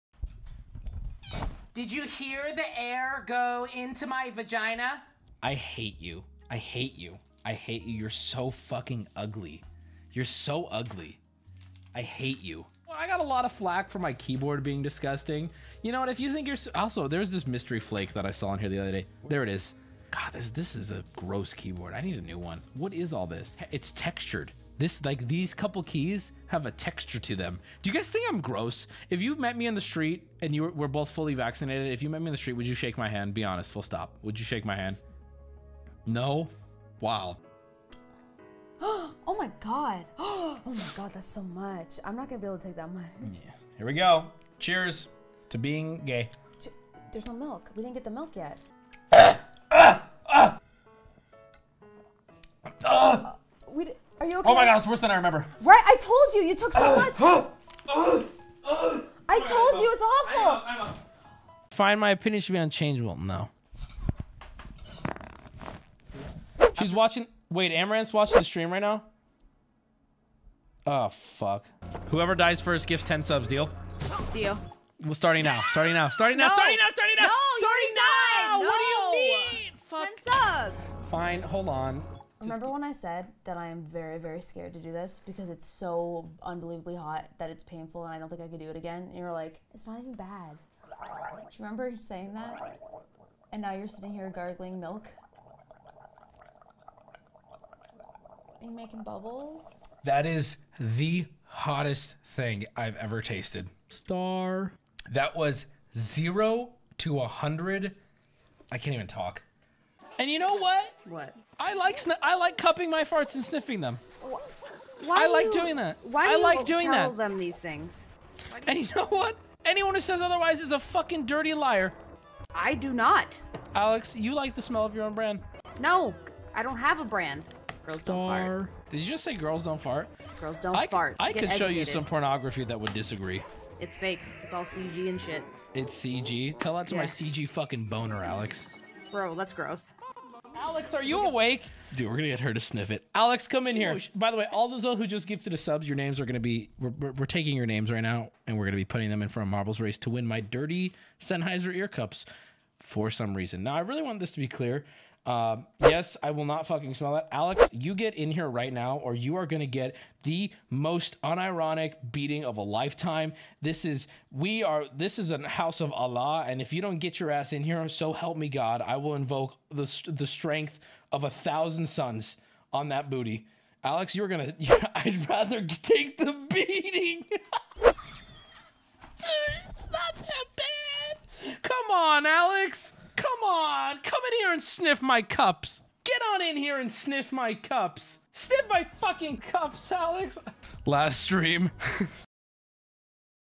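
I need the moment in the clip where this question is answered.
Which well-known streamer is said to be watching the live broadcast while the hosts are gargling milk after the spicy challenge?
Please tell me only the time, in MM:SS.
01:07.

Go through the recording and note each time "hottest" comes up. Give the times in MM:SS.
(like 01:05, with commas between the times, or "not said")
01:41.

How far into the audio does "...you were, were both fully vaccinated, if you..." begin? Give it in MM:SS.
00:30.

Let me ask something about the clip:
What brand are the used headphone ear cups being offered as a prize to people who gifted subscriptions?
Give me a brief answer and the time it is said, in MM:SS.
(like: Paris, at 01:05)
Sennheiser, at 02:31.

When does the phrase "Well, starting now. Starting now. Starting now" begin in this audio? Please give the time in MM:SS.
01:15.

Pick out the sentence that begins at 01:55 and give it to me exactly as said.
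Why I like you, doing that.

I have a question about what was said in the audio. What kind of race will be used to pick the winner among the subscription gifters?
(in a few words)
Marbles race.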